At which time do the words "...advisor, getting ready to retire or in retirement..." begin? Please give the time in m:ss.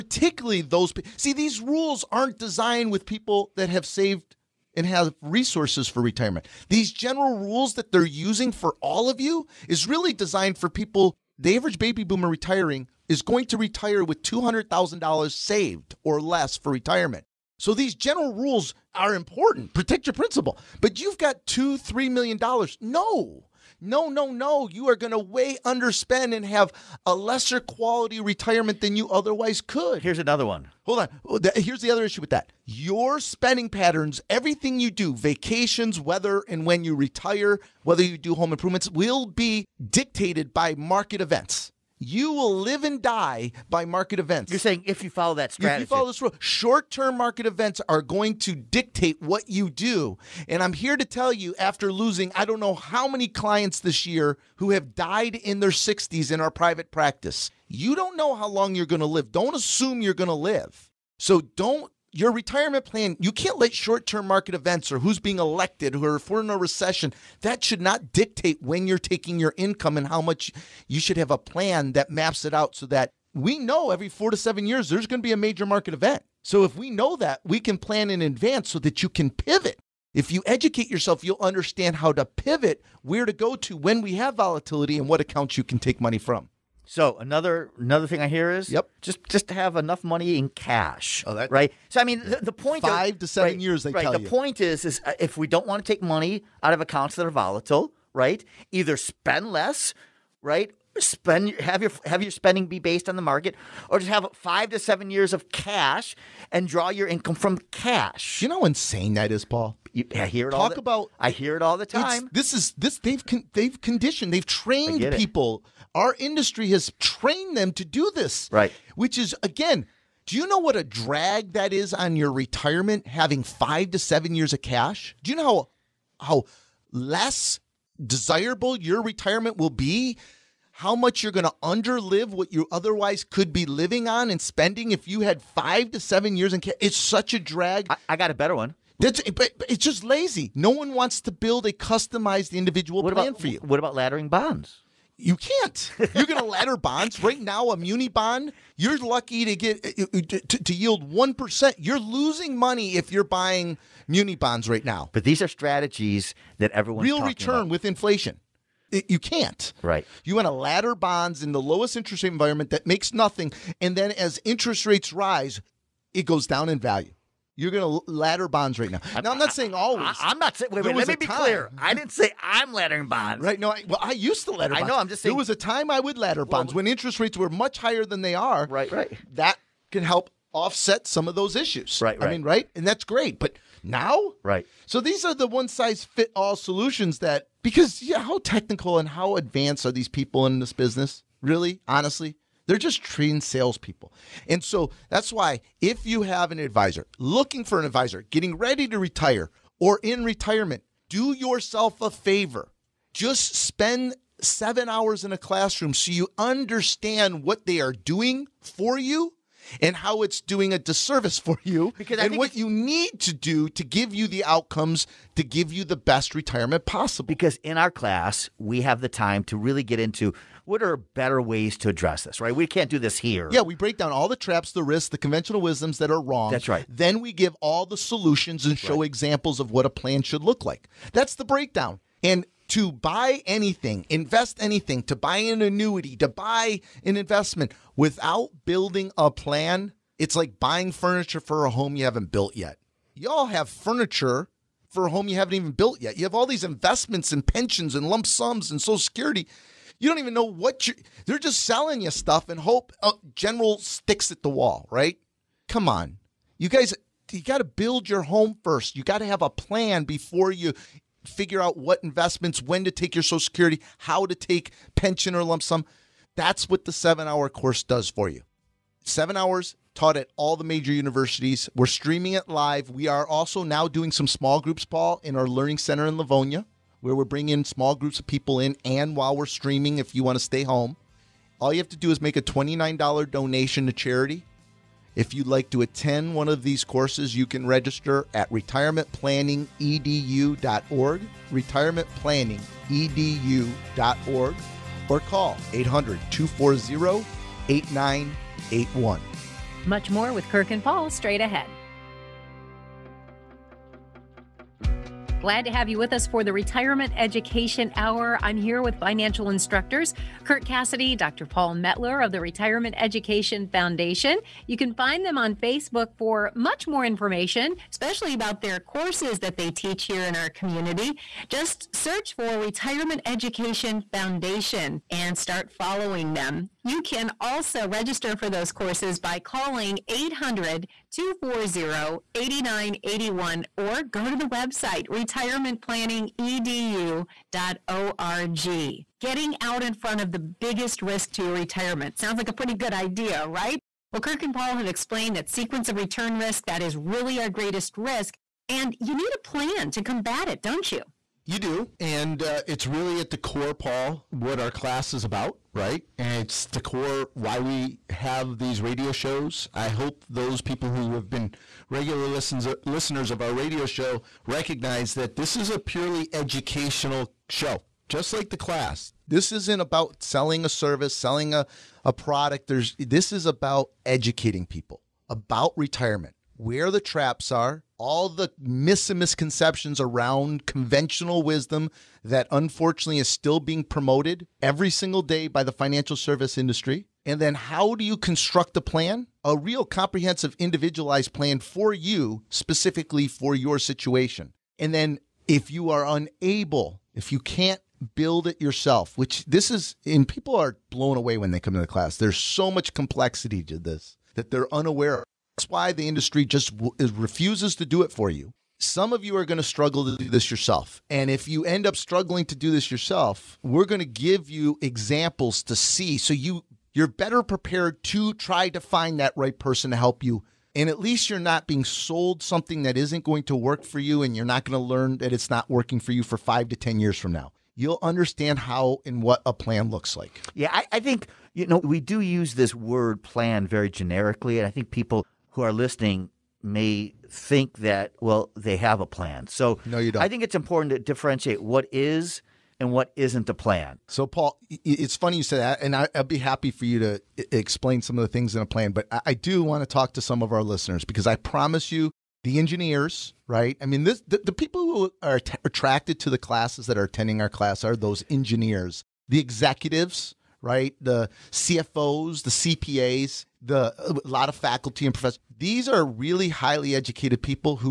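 3:17.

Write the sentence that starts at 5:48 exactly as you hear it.
And you need a plan to combat it, don't you?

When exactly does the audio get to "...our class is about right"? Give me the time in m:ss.
5:54.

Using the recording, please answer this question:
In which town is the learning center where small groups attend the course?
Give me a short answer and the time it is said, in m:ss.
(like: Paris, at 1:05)
Livonia, at 4:36.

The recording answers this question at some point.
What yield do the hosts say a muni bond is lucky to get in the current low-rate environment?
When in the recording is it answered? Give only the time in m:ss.
2:31.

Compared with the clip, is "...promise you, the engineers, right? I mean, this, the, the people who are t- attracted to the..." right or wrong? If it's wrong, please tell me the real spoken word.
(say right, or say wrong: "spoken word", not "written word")
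right.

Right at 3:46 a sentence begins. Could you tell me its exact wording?
Then we give all the solutions and That's show right.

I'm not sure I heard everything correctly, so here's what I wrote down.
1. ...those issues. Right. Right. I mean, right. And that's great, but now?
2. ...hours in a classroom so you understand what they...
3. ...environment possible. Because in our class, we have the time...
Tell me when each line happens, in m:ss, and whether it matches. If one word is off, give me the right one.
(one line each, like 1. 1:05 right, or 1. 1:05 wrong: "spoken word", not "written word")
1. 3:01 right
2. 3:24 right
3. 3:36 wrong: "retirement", not "environment".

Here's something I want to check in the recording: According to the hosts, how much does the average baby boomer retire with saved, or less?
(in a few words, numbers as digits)
$200,000.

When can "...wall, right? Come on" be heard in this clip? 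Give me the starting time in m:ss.
4:14.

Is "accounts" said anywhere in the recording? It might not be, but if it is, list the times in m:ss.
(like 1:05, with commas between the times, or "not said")
1:25, 1:36.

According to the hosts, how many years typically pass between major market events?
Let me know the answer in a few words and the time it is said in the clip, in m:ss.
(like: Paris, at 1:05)
4 to 7 years, at 1:13.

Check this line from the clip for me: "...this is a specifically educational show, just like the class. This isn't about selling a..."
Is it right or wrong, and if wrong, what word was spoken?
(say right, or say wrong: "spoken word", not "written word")
wrong: "purely", not "specifically".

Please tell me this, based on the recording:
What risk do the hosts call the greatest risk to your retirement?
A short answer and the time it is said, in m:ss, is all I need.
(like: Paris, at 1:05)
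sequence of return risk, at 5:45.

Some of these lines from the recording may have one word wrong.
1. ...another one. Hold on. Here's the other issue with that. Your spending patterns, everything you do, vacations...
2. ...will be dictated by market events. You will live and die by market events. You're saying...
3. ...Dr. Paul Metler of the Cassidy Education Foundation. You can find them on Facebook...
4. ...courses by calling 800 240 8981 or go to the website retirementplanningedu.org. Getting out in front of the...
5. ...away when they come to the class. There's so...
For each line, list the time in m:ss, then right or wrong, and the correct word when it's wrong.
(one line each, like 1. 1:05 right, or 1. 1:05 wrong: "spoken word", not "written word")
1. 0:30 right
2. 0:38 right
3. 5:11 wrong: "Retirement", not "Cassidy"
4. 5:28 right
5. 6:41 right.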